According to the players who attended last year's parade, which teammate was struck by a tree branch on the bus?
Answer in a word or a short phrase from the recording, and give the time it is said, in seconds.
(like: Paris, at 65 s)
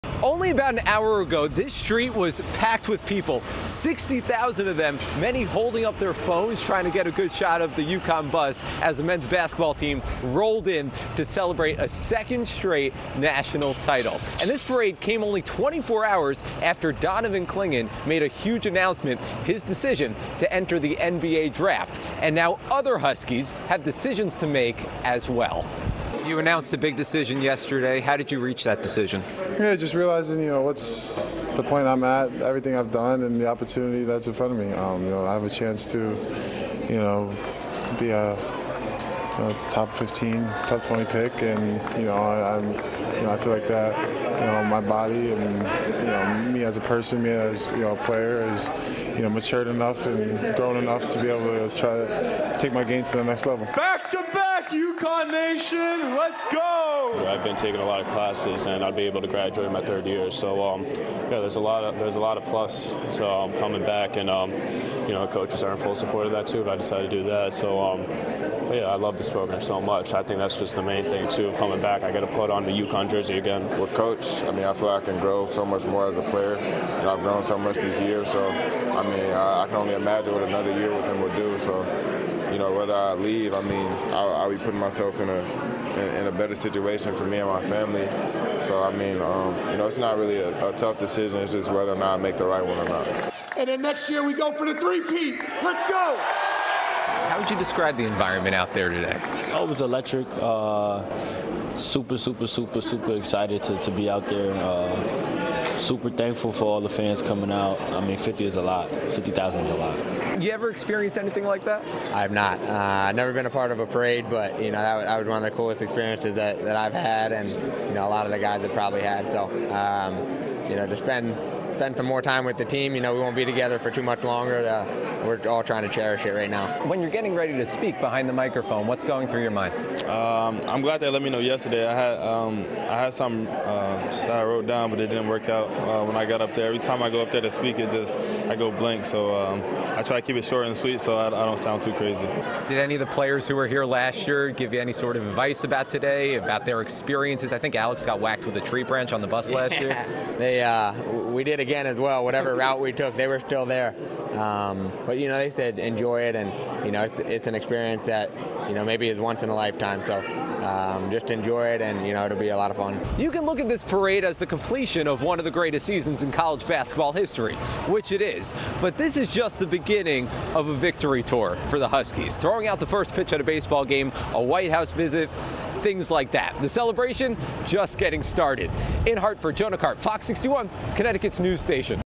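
Alex, at 147 s.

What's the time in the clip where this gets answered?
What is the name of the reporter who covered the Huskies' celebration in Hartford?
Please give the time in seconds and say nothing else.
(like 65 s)
179 s.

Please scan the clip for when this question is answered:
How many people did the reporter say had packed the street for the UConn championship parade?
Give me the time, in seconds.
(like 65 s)
3 s.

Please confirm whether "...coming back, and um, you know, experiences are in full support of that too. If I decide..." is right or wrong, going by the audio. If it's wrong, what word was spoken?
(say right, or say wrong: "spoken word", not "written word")
wrong: "coaches", not "experiences".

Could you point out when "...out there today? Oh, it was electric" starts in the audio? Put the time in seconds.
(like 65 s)
98 s.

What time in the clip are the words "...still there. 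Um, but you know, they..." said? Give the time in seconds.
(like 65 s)
153 s.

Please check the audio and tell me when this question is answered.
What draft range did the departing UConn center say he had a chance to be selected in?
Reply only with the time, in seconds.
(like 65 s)
39 s.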